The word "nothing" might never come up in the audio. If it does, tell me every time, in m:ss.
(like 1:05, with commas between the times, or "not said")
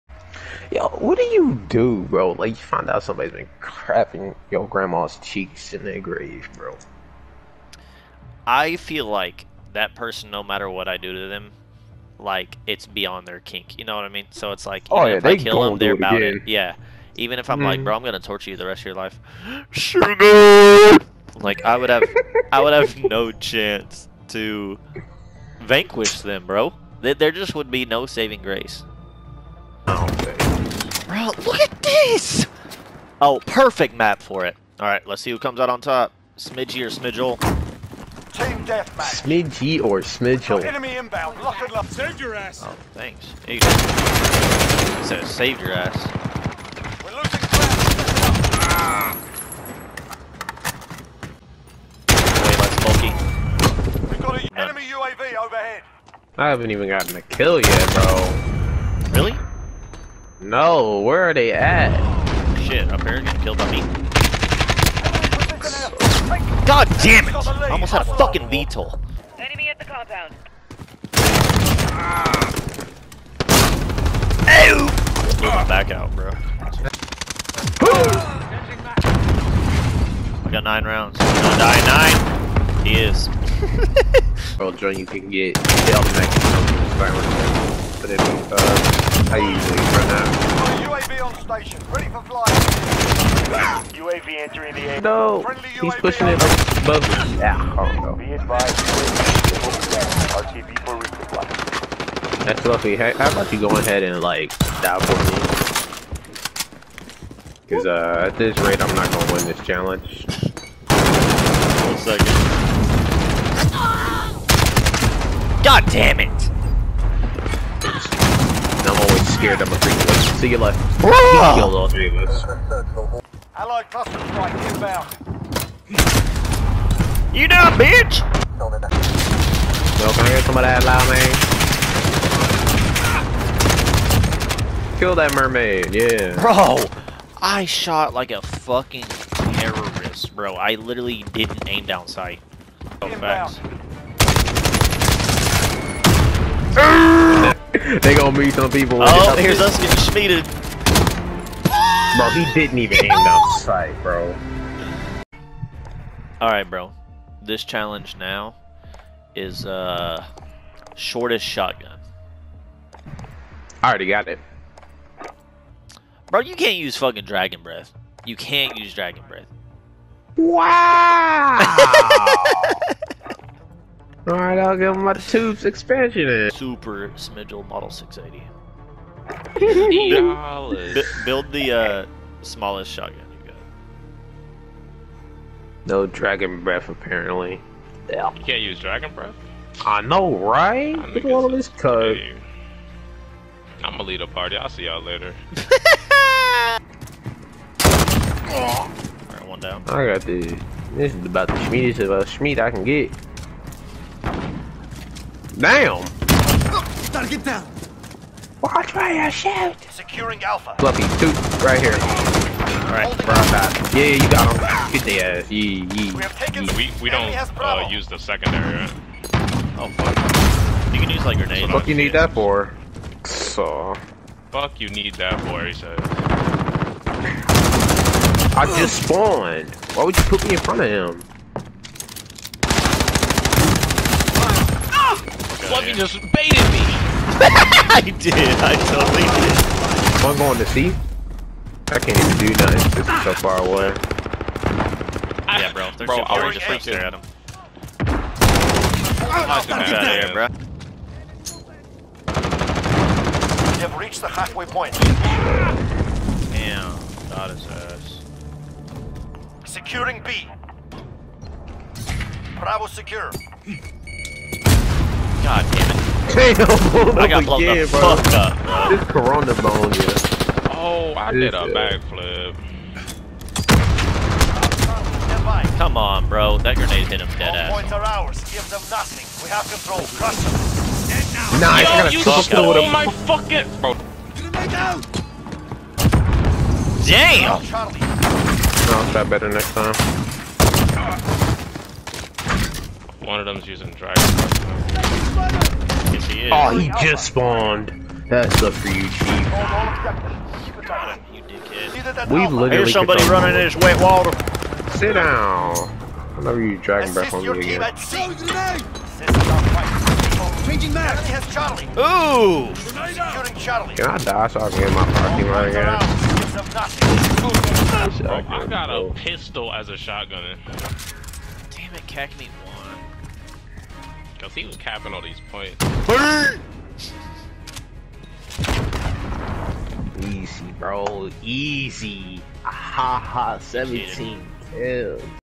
4:02, 4:38.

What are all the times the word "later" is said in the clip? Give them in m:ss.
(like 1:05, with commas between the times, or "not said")
2:00, 3:15.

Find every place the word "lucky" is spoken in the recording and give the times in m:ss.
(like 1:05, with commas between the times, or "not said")
1:42.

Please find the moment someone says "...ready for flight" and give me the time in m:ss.
1:31.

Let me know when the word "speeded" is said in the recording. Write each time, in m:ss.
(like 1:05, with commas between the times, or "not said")
2:29.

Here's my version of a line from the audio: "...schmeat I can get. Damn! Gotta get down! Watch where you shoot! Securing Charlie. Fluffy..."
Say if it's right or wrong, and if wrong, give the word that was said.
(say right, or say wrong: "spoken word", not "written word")
wrong: "Alpha", not "Charlie".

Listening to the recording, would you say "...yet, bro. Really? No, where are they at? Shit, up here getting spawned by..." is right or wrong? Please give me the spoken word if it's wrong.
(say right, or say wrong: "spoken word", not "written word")
wrong: "killed", not "spawned".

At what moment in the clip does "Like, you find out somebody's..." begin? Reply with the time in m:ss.
0:02.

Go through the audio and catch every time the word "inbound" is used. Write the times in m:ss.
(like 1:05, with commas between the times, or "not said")
0:40, 2:04.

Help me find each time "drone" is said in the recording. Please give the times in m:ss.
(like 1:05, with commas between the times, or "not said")
1:24.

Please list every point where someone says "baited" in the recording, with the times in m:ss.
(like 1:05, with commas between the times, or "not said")
3:56.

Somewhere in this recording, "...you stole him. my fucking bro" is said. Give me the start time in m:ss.
4:42.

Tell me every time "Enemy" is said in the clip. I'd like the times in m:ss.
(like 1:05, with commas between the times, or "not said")
0:40, 0:54, 1:09.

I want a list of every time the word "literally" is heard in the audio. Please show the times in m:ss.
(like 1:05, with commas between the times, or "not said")
2:20, 5:02.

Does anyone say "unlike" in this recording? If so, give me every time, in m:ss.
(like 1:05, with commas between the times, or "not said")
not said.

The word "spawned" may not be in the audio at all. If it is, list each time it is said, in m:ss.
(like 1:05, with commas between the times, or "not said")
3:49, 4:57.